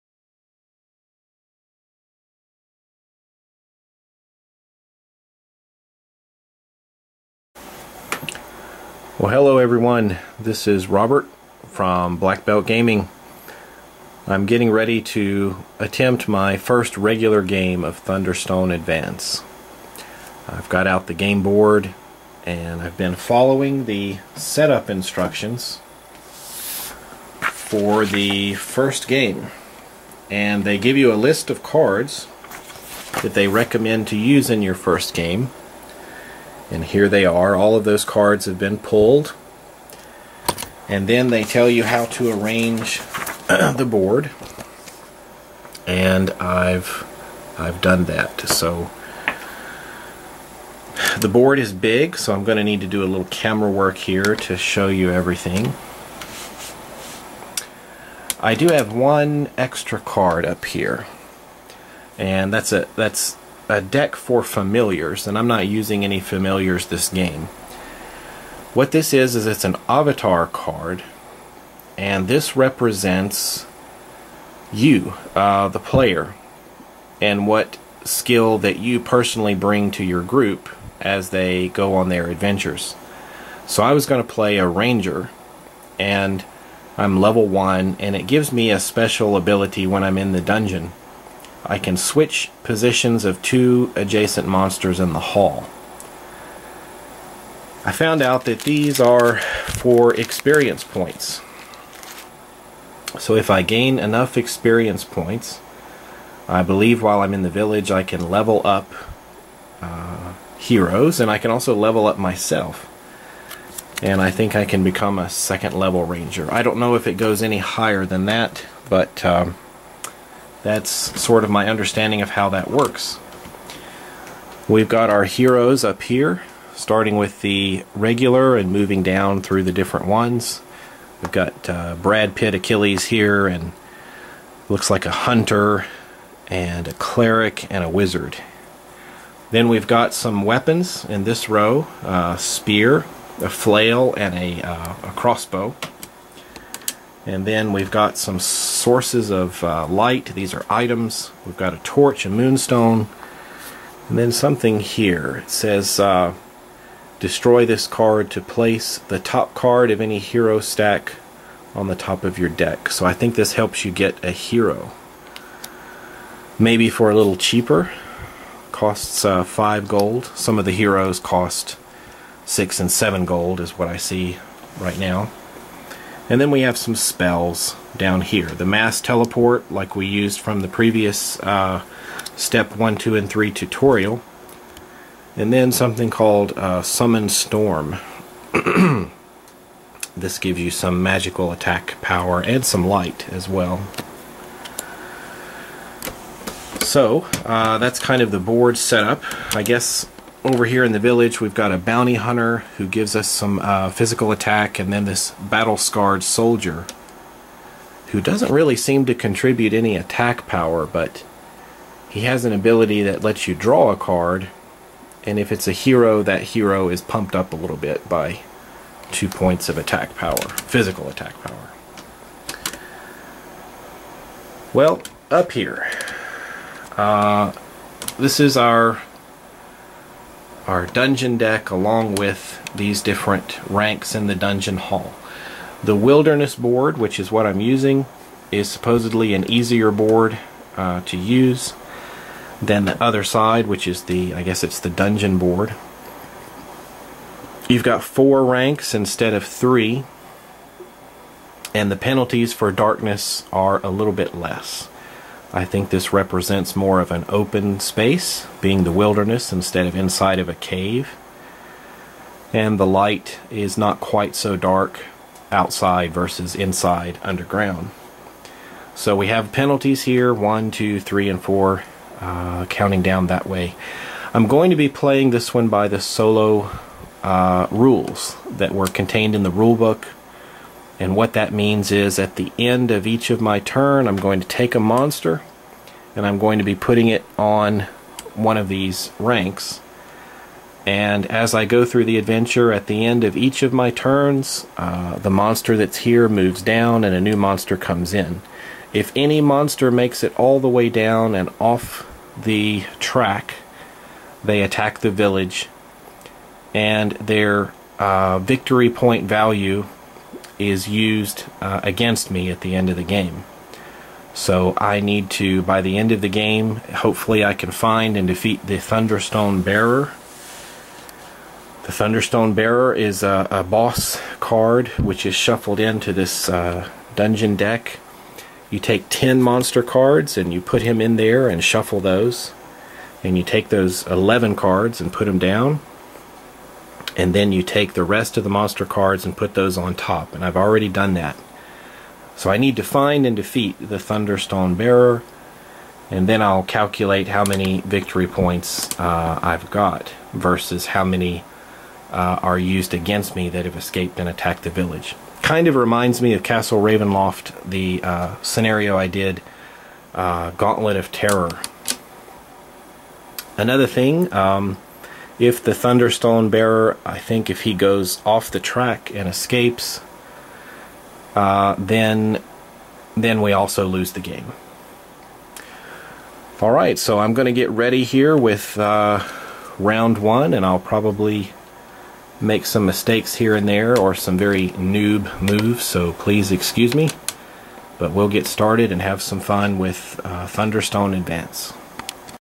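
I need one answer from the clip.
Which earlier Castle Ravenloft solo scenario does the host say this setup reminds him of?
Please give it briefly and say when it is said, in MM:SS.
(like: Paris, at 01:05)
Gauntlet of Terror, at 06:00.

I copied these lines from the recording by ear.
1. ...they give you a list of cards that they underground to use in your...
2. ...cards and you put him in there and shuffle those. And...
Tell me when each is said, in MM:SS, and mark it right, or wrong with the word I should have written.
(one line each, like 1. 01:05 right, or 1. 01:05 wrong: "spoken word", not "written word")
1. 00:30 wrong: "recommend", not "underground"
2. 05:29 right.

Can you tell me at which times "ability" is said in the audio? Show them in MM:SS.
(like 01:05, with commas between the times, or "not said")
01:29, 03:32.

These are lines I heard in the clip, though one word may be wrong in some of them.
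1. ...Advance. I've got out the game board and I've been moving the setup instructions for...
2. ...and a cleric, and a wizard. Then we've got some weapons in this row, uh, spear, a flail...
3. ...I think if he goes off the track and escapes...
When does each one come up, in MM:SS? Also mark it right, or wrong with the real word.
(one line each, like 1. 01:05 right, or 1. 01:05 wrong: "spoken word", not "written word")
1. 00:18 wrong: "following", not "moving"
2. 02:16 right
3. 06:07 right.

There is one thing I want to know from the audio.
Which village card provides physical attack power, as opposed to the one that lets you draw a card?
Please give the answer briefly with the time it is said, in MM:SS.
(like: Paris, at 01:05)
Bounty hunter, at 03:21.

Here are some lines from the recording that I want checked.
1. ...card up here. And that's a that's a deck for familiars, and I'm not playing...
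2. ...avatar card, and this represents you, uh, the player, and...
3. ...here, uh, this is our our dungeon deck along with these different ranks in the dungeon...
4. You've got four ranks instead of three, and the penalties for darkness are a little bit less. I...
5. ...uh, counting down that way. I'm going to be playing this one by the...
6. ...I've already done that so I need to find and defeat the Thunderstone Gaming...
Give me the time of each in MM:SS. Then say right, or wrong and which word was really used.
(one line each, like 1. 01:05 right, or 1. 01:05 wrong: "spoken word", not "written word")
1. 00:59 wrong: "using", not "playing"
2. 01:09 right
3. 03:45 right
4. 04:07 right
5. 04:32 right
6. 05:40 wrong: "Bearer", not "Gaming".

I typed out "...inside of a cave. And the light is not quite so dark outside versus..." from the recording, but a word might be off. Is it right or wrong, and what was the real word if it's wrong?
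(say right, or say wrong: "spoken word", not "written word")
right.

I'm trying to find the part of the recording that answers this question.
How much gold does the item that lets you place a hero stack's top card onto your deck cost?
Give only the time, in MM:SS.
02:49.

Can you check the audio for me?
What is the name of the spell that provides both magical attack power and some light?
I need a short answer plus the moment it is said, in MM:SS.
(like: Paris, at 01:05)
Summon Storm, at 03:06.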